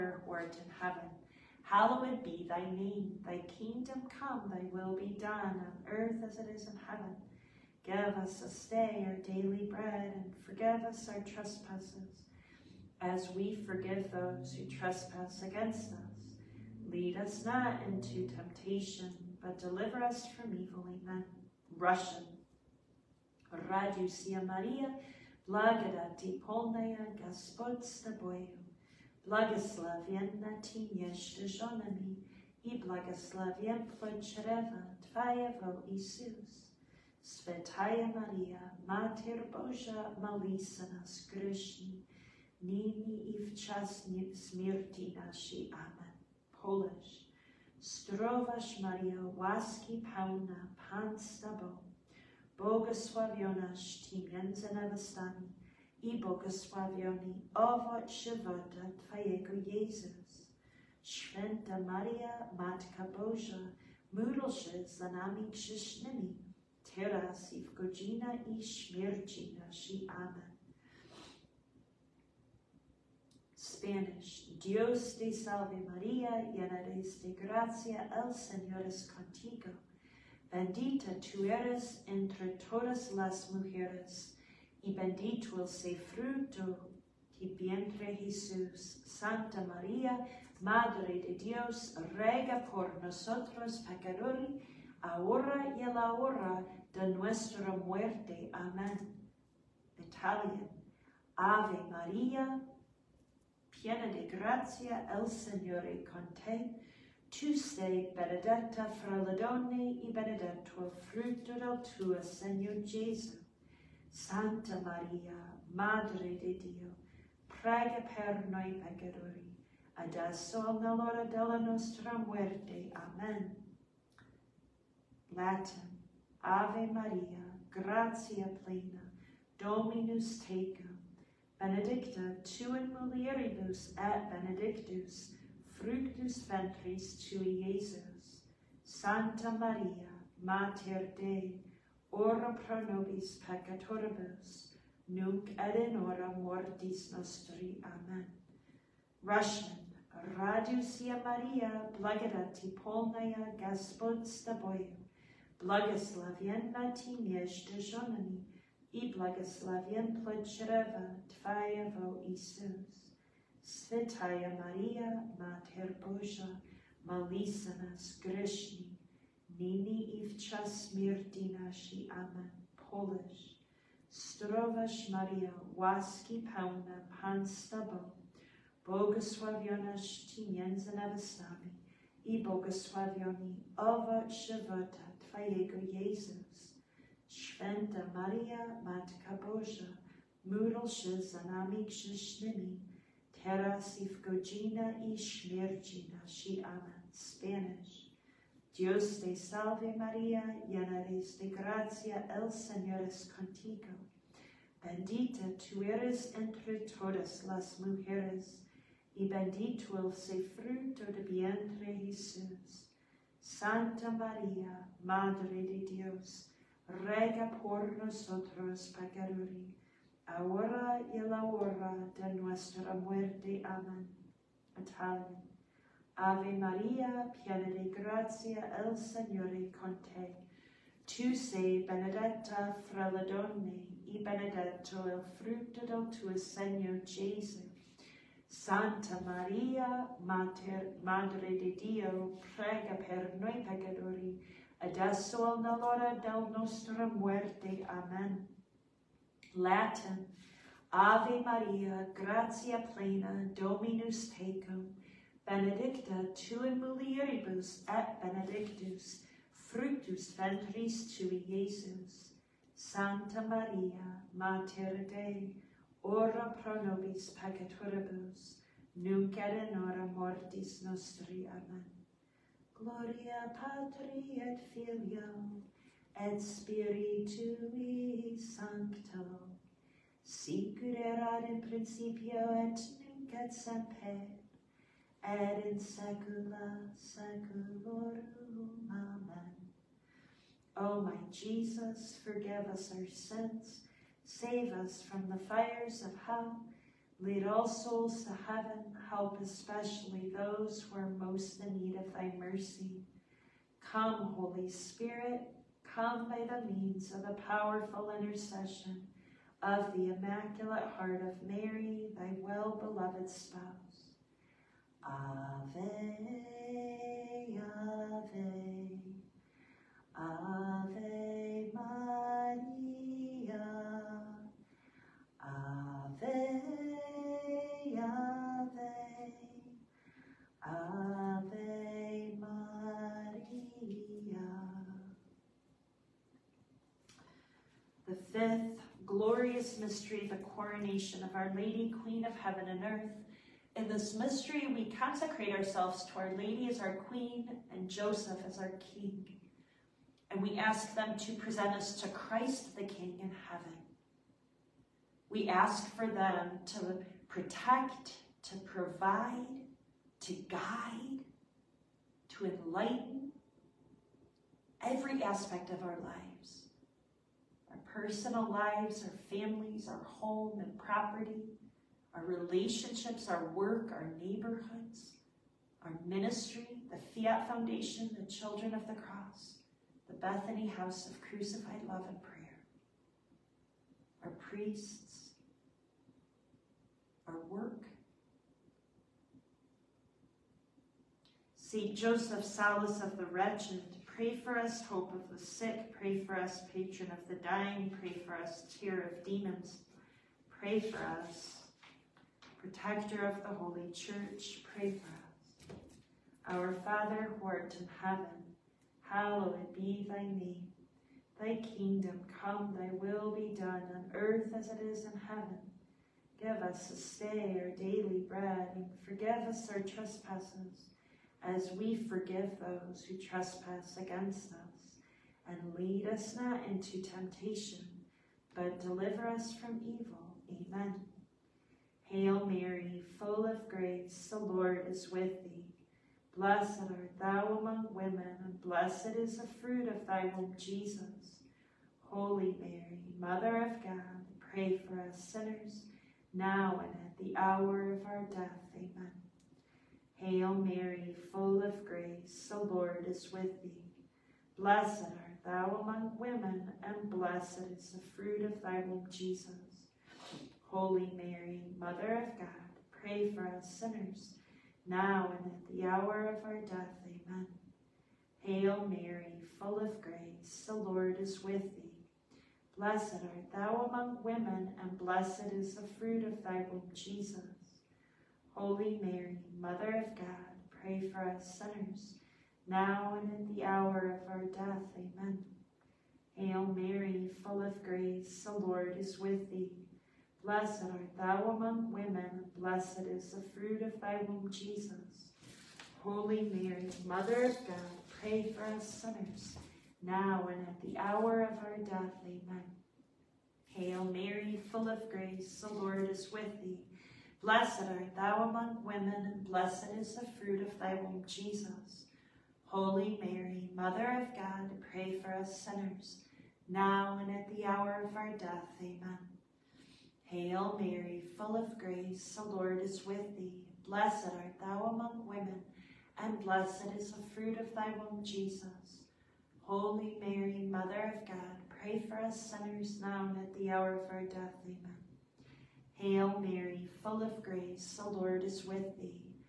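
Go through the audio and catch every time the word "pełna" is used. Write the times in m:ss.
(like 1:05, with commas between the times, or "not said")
0:50, 2:56.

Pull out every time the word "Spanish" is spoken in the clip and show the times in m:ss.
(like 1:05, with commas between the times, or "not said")
1:13, 3:17.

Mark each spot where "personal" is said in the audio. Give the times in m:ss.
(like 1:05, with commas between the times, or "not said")
6:07.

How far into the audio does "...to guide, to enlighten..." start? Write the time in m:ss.
6:00.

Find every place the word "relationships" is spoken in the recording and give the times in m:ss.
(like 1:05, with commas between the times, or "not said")
6:12.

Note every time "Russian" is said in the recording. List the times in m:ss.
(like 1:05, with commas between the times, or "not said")
0:21, 2:29.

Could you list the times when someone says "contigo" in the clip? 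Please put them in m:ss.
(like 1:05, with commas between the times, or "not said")
1:19, 1:46, 3:23.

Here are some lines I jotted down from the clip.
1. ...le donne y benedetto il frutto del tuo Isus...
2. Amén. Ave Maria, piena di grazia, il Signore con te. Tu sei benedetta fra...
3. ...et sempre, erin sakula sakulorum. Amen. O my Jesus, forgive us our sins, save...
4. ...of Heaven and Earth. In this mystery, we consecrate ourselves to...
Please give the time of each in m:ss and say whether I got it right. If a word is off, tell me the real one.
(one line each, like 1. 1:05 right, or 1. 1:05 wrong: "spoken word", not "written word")
1. 1:49 wrong: "Señor", not "Isus"
2. 3:43 right
3. 4:43 right
4. 5:42 right.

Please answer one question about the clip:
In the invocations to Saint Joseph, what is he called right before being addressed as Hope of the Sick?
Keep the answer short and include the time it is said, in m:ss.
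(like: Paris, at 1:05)
Solace of the Wretched, at 6:32.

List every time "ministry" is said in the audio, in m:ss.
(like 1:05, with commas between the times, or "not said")
6:16.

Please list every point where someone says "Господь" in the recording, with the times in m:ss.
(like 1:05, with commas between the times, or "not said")
0:27.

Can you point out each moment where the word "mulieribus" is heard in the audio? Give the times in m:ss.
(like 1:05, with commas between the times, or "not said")
2:12, 4:16.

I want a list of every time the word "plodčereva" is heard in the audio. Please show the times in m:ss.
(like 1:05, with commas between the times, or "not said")
2:40.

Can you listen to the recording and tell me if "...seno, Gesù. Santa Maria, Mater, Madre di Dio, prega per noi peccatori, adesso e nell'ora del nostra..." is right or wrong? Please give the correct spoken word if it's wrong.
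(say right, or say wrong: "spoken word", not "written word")
right.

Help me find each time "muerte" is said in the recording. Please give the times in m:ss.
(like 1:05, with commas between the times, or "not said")
1:37, 2:02, 3:42.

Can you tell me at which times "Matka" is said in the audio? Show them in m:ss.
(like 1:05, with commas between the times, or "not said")
1:02, 3:08.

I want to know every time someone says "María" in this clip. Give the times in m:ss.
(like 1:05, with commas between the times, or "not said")
1:29, 1:41, 3:19, 3:34.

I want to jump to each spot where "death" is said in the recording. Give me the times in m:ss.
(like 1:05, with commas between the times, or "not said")
7:28, 7:46, 8:04, 8:21, 8:38, 8:54.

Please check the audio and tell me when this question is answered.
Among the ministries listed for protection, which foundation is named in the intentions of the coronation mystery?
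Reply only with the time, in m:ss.
6:16.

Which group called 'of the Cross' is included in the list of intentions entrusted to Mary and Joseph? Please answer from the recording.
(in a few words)
Children of the Cross.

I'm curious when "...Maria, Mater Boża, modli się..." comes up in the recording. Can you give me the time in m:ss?
0:38.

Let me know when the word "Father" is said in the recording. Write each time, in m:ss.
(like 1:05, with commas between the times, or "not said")
6:46.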